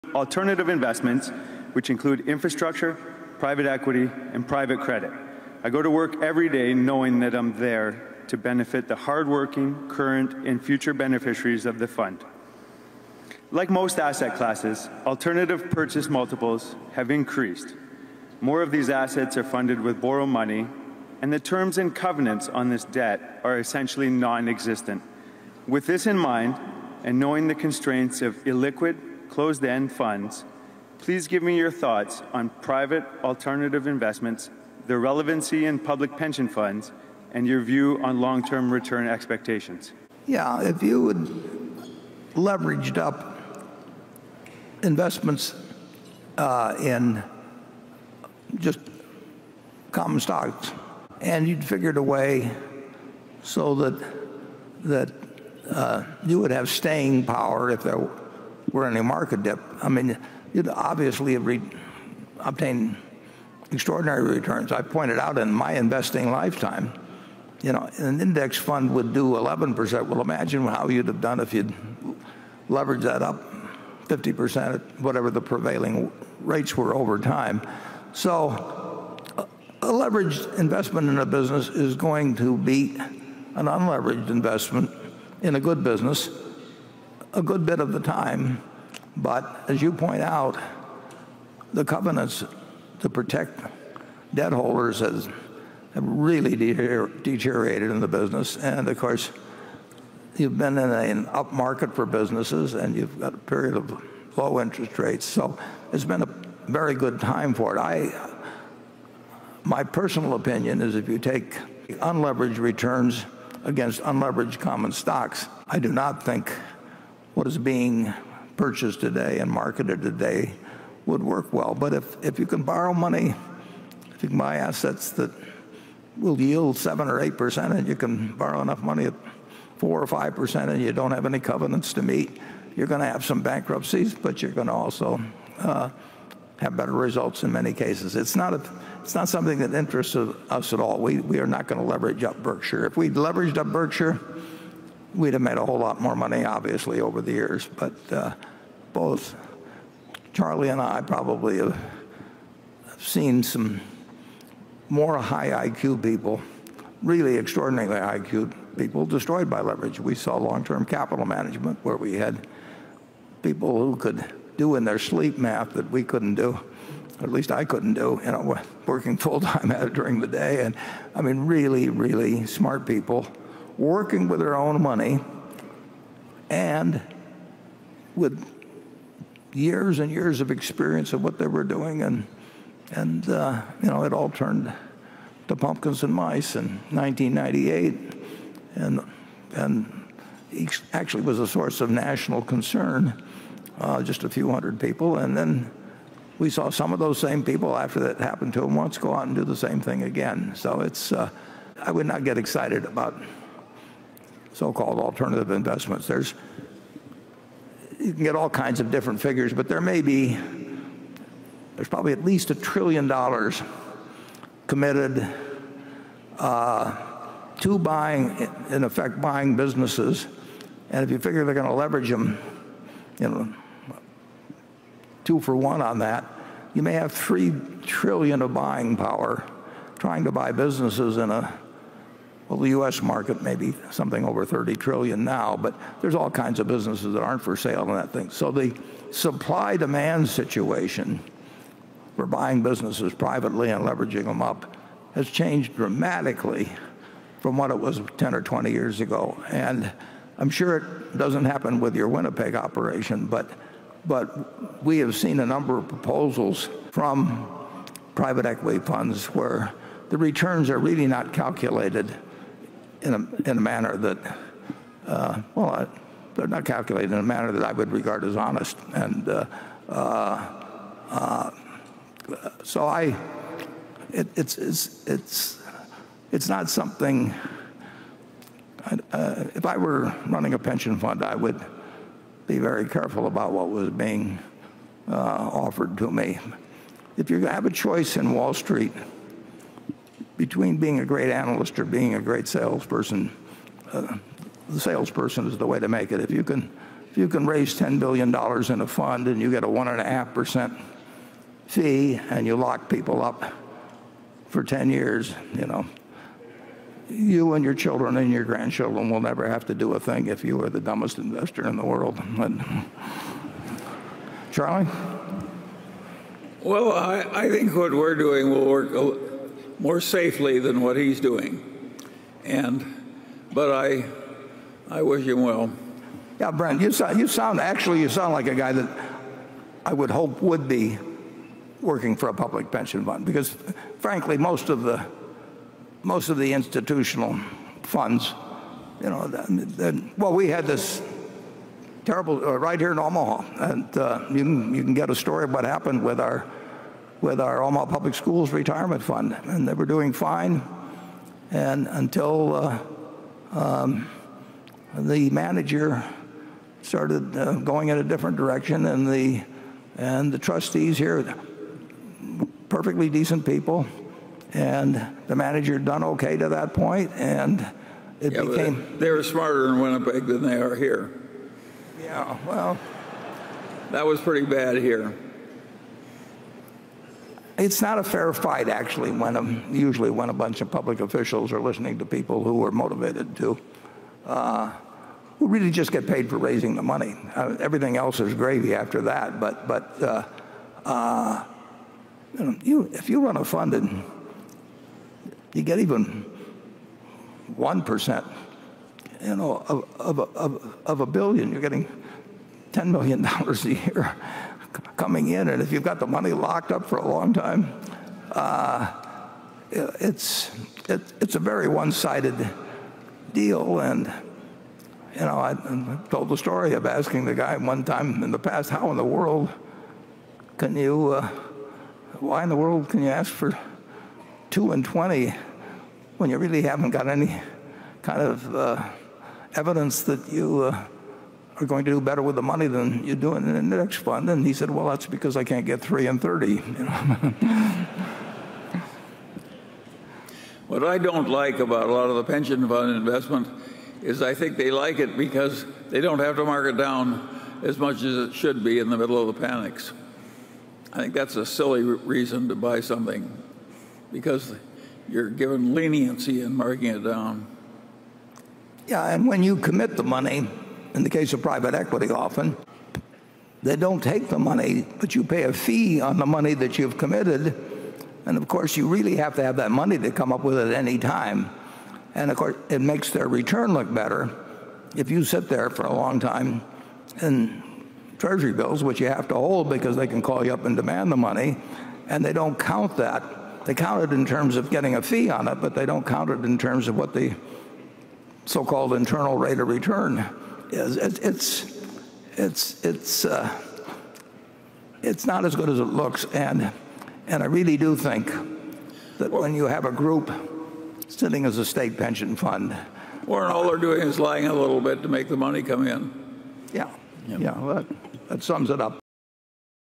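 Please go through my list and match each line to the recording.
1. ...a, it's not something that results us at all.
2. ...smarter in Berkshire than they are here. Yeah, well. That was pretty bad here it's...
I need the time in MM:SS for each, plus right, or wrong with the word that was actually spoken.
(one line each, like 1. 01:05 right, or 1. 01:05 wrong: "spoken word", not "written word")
1. 02:18 wrong: "interests", not "results"
2. 06:09 wrong: "Winnipeg", not "Berkshire".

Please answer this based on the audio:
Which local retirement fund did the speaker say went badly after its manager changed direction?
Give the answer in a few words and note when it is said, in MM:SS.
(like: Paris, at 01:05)
Omaha Public Schools Retirement Fund, at 05:47.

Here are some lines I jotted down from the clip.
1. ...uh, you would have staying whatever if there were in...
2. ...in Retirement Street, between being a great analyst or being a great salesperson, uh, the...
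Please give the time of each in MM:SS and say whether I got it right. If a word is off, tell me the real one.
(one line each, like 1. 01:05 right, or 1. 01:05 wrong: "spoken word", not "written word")
1. 00:55 wrong: "power", not "whatever"
2. 04:48 wrong: "Wall", not "Retirement".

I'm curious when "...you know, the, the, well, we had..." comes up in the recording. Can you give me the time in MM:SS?
05:39.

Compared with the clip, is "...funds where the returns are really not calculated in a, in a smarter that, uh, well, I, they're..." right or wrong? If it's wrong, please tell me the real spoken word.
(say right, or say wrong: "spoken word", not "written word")
wrong: "manner", not "smarter".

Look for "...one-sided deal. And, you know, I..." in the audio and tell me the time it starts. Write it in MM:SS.
06:51.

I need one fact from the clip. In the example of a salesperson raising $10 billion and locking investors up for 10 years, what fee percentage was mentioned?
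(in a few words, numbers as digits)
1.5%.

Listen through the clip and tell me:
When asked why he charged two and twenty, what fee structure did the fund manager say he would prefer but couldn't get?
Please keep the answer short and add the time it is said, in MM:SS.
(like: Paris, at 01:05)
three and 30, at 07:15.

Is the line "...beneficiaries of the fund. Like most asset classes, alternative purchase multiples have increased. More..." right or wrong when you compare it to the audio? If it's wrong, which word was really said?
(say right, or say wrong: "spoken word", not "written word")
right.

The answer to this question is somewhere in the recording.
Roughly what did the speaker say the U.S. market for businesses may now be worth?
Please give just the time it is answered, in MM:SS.
03:53.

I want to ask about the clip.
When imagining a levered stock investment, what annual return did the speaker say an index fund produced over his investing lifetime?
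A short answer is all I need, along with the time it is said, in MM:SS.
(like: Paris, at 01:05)
11%, at 01:09.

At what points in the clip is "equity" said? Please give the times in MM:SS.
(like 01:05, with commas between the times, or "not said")
00:03, 04:18, 07:41.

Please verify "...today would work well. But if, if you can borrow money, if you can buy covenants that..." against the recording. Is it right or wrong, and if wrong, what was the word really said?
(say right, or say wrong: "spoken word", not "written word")
wrong: "assets", not "covenants".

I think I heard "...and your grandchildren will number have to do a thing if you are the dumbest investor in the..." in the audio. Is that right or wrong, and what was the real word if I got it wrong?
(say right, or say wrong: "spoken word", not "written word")
wrong: "never", not "number".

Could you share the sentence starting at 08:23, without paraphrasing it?
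Warren, all they're doing is lying a little bit to make the money come in.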